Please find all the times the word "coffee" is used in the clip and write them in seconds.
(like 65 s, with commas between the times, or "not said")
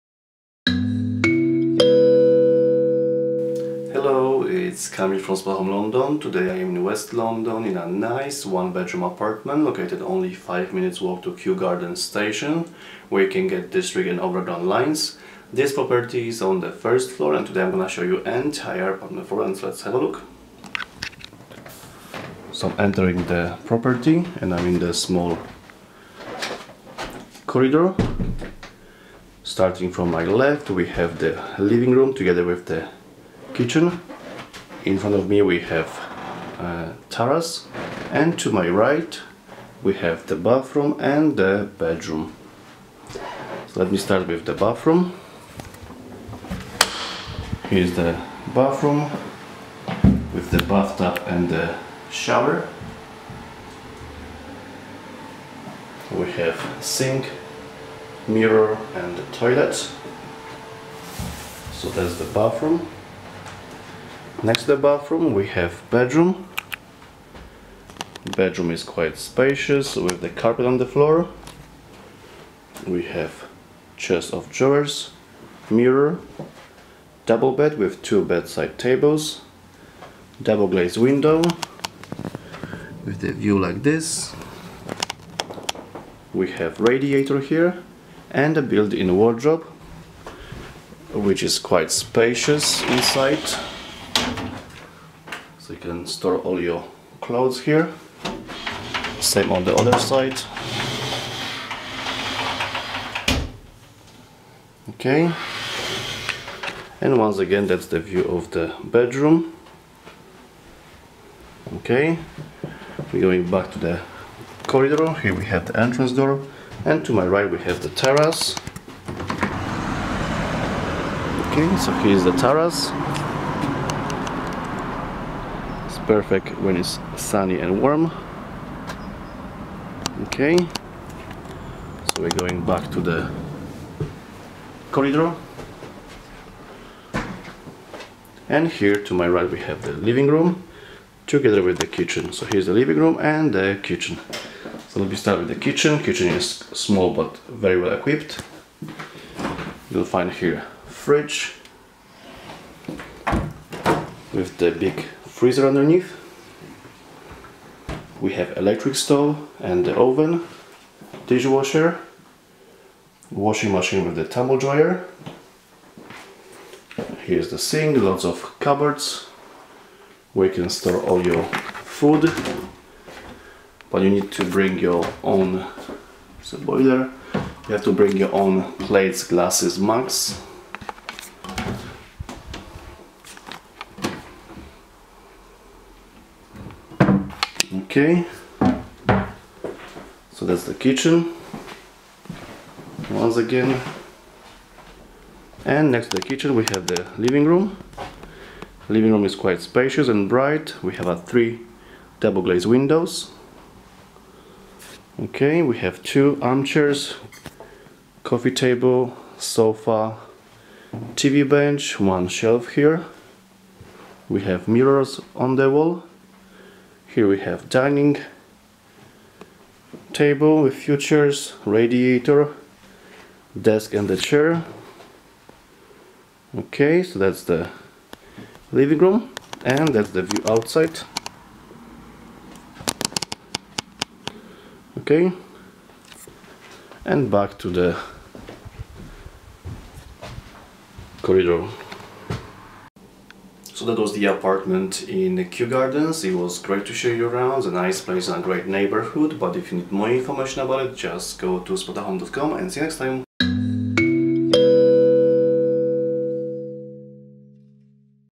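208 s.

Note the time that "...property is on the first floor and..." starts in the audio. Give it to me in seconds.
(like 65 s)
15 s.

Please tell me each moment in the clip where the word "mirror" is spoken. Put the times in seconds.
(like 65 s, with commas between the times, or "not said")
58 s, 75 s, 214 s.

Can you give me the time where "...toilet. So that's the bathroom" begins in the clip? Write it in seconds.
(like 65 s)
59 s.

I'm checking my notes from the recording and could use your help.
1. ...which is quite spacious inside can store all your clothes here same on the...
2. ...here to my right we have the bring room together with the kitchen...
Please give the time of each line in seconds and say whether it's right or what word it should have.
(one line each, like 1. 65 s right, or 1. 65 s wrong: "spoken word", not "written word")
1. 91 s right
2. 138 s wrong: "living", not "bring".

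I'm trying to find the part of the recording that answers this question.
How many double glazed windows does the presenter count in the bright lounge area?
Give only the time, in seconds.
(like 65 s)
201 s.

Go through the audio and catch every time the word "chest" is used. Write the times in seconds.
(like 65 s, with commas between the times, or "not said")
73 s.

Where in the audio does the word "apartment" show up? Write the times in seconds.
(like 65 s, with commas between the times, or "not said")
9 s, 18 s, 244 s.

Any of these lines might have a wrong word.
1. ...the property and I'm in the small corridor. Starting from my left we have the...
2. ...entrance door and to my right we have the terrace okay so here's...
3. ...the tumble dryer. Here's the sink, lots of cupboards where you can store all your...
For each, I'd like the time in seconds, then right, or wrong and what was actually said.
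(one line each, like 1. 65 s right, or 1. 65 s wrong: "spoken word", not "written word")
1. 23 s right
2. 115 s right
3. 164 s right.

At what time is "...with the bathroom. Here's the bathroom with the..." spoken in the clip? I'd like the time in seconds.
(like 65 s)
44 s.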